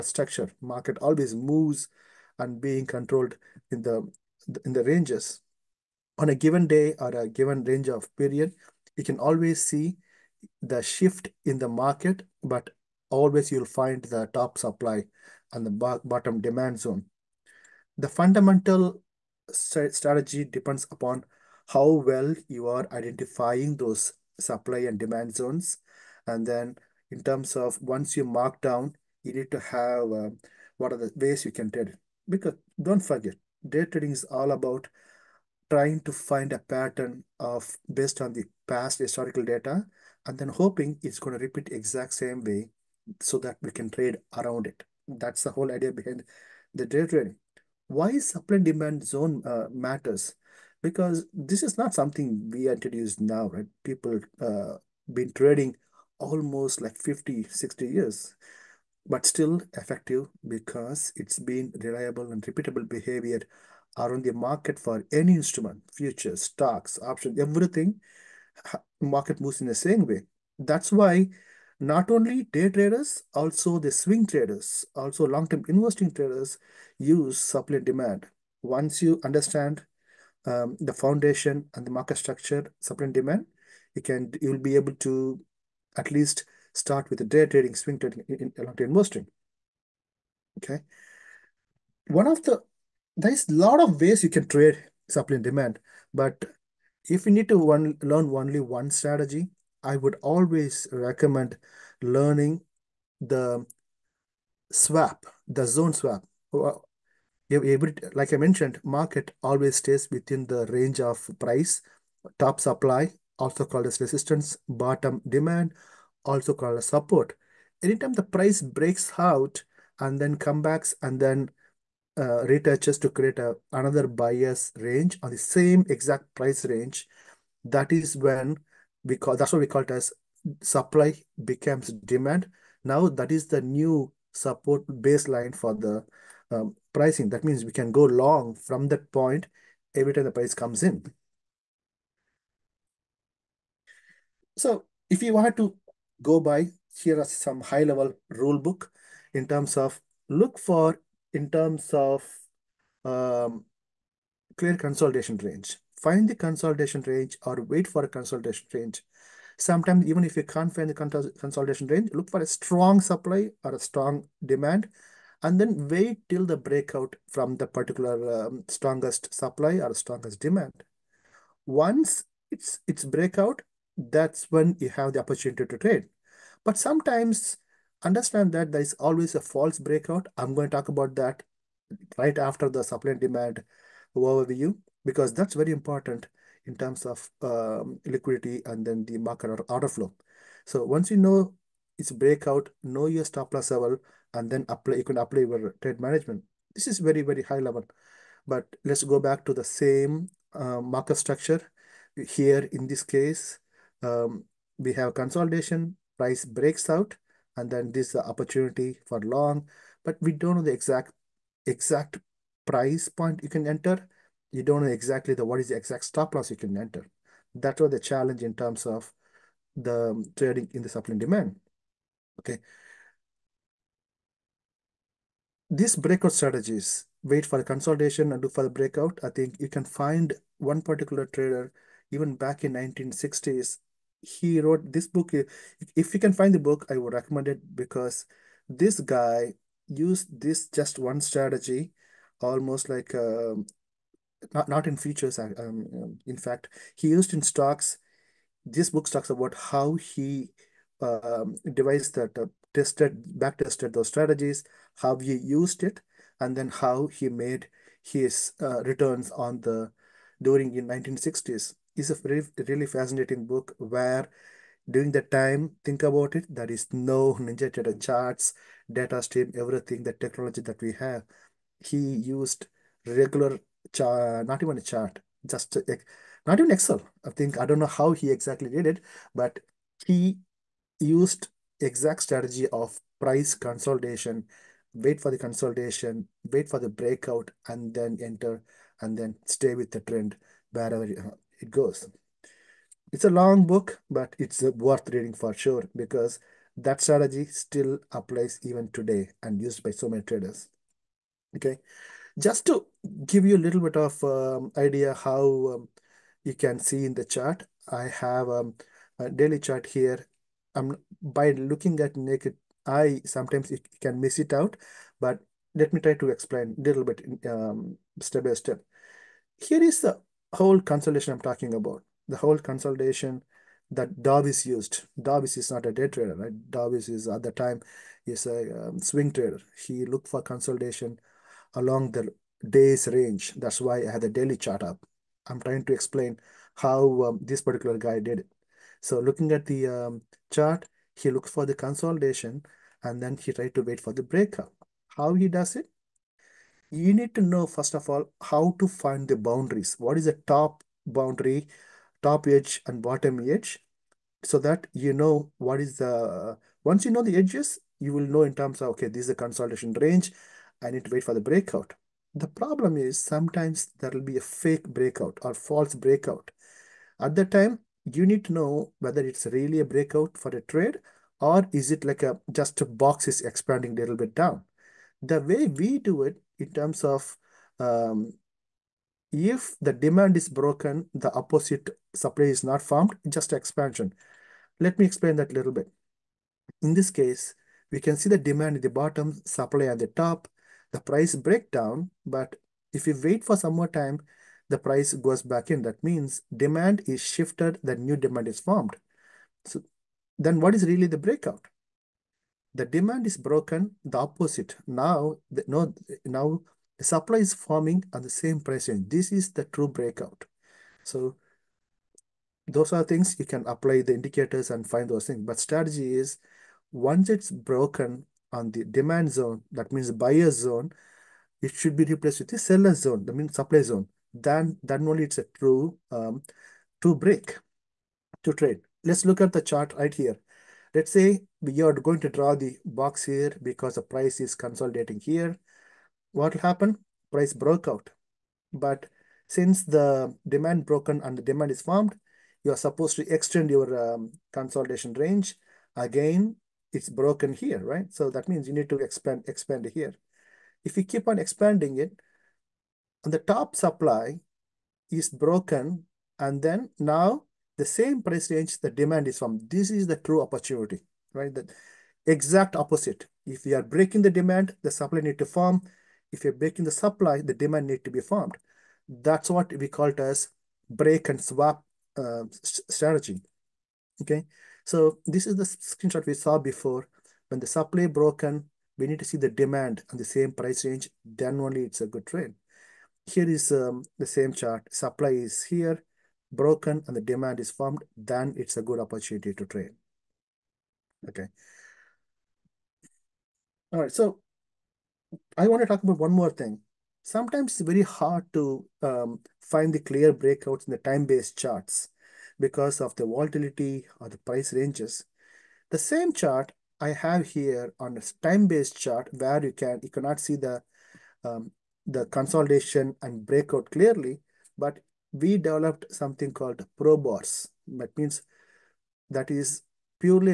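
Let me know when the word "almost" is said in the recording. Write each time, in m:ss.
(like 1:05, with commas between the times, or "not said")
0:56, 4:02.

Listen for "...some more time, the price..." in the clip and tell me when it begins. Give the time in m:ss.
6:33.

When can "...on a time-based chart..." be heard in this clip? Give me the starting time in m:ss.
8:27.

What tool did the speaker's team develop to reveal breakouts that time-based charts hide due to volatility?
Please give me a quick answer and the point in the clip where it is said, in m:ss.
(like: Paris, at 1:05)
Probars, at 8:36.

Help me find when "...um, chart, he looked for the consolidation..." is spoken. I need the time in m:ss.
5:39.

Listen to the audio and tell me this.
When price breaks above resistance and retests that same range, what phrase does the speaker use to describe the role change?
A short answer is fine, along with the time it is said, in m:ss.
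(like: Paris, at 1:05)
Supply becomes demand, at 2:10.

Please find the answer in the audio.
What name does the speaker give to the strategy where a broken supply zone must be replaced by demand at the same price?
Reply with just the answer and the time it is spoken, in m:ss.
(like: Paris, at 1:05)
Break and swap, at 7:50.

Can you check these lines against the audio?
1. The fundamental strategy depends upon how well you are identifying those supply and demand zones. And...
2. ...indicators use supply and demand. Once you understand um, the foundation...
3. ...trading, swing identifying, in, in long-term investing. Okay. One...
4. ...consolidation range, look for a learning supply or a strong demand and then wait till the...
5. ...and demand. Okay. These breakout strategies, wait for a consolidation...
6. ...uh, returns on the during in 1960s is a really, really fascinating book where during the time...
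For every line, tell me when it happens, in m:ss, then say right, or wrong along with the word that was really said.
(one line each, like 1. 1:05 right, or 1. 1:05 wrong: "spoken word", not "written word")
1. 0:17 right
2. 1:16 wrong: "traders", not "indicators"
3. 1:27 wrong: "trading", not "identifying"
4. 2:41 wrong: "strong", not "learning"
5. 3:41 right
6. 4:18 right.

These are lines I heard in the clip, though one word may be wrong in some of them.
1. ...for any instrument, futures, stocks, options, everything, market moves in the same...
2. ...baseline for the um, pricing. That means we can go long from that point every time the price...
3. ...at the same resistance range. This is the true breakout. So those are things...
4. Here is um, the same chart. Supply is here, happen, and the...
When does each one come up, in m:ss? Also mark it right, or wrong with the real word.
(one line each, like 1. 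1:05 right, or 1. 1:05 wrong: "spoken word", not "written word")
1. 1:04 right
2. 2:14 right
3. 6:48 wrong: "price", not "resistance"
4. 8:03 wrong: "broken", not "happen".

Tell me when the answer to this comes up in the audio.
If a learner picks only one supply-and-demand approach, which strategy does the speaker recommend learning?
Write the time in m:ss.
1:45.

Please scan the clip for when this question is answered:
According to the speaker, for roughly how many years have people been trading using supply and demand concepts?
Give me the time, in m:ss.
0:56.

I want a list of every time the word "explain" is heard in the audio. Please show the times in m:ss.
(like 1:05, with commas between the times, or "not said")
5:16, 5:35, 6:25.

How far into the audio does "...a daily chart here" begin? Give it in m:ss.
5:09.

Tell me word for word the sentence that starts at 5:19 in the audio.
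Here is the whole consolidation I'm talking about, the whole consolidation that Darvas used.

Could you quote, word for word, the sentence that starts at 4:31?
He used regular chart, not even a chart, just a, not even Excel.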